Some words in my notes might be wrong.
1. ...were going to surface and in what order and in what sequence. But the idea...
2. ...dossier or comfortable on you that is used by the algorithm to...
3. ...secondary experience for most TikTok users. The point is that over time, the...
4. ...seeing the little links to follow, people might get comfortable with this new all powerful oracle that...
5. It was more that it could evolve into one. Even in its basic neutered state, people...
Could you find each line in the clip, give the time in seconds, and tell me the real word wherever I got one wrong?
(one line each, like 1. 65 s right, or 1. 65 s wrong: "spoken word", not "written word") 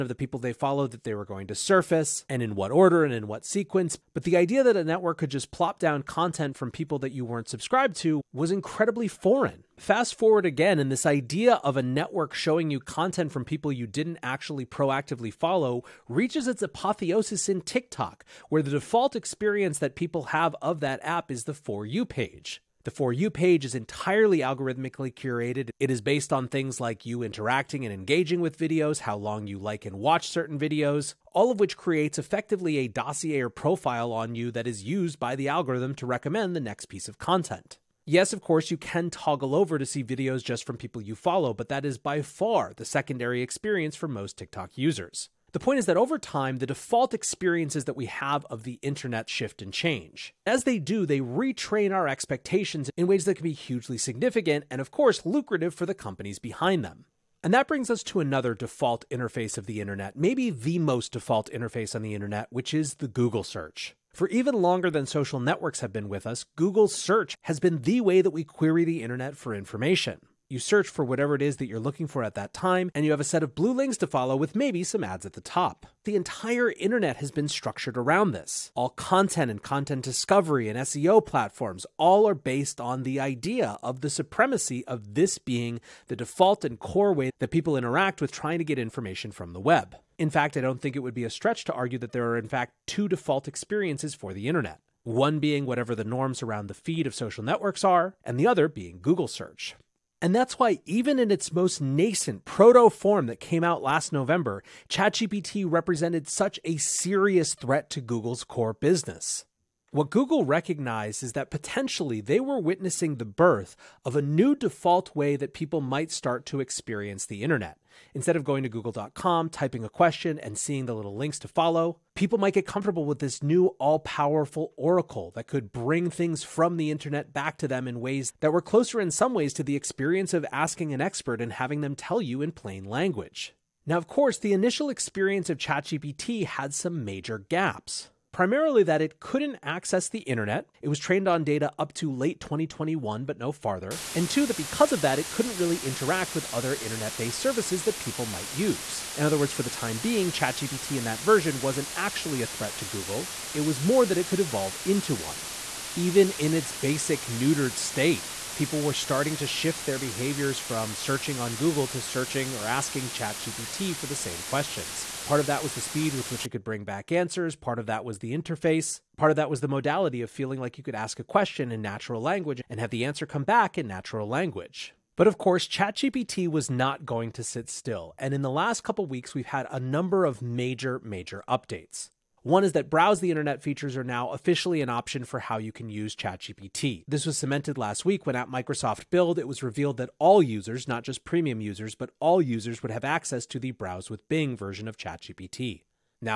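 1. 1 s right
2. 32 s wrong: "profile", not "comfortable"
3. 42 s right
4. 120 s right
5. 153 s right.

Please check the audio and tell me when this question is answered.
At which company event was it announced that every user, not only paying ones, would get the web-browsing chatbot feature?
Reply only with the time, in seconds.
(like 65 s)
188 s.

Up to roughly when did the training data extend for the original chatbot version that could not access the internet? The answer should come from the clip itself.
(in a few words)
late 2021.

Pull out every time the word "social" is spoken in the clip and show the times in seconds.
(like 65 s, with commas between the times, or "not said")
65 s, 97 s.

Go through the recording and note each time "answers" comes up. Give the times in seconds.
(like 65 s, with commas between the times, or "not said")
167 s, 173 s.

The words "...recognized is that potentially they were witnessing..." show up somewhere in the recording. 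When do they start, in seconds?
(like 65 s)
110 s.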